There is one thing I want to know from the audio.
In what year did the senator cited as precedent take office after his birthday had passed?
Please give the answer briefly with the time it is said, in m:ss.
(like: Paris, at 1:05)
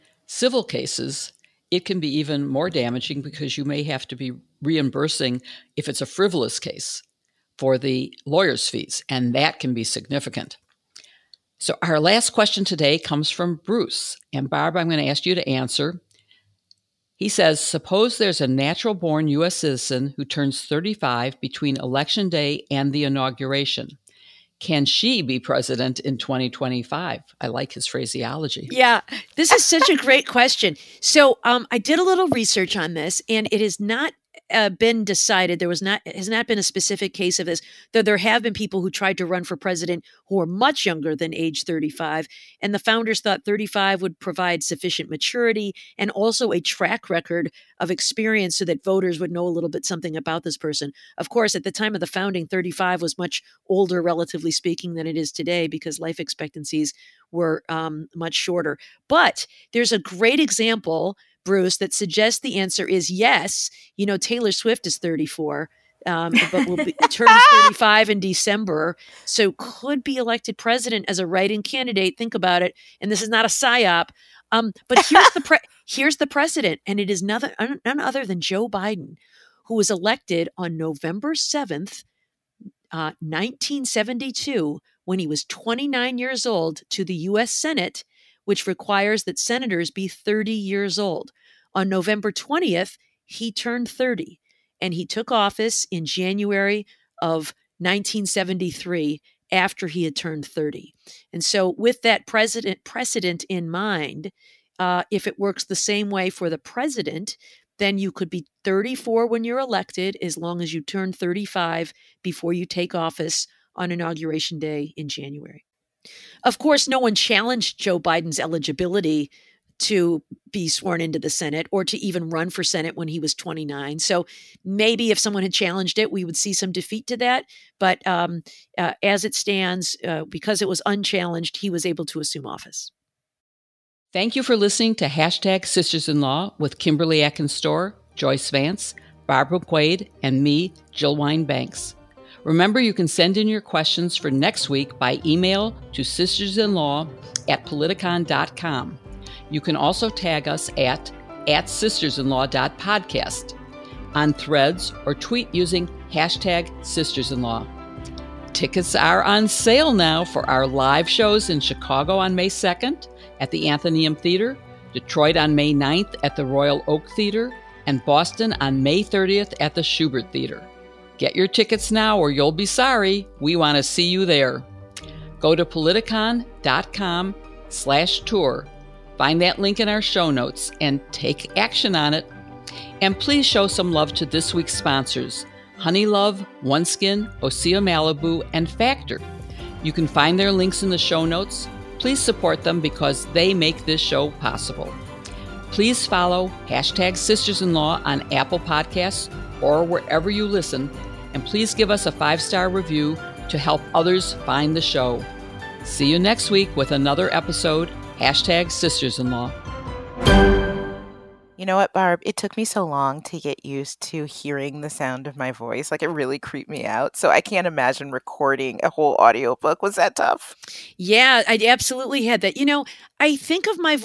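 1973, at 1:37.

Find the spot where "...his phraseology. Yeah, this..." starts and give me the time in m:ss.
0:27.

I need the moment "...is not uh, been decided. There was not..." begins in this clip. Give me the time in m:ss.
0:33.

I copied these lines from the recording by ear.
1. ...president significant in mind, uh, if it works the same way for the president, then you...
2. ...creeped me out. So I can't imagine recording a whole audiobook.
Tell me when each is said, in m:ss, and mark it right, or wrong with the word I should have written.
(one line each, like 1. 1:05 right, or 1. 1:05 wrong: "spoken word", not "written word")
1. 1:42 wrong: "precedent", not "significant"
2. 3:36 right.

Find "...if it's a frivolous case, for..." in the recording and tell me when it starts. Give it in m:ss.
0:05.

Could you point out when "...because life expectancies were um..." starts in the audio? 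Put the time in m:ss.
0:55.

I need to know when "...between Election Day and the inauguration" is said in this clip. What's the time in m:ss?
0:21.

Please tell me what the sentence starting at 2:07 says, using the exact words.
But um, uh, as it stands, uh, because it was unchallenged, he was able to assume office.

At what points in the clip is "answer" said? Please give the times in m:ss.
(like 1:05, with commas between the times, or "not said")
0:15, 1:02.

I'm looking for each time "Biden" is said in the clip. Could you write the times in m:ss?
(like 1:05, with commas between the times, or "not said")
1:18, 1:57.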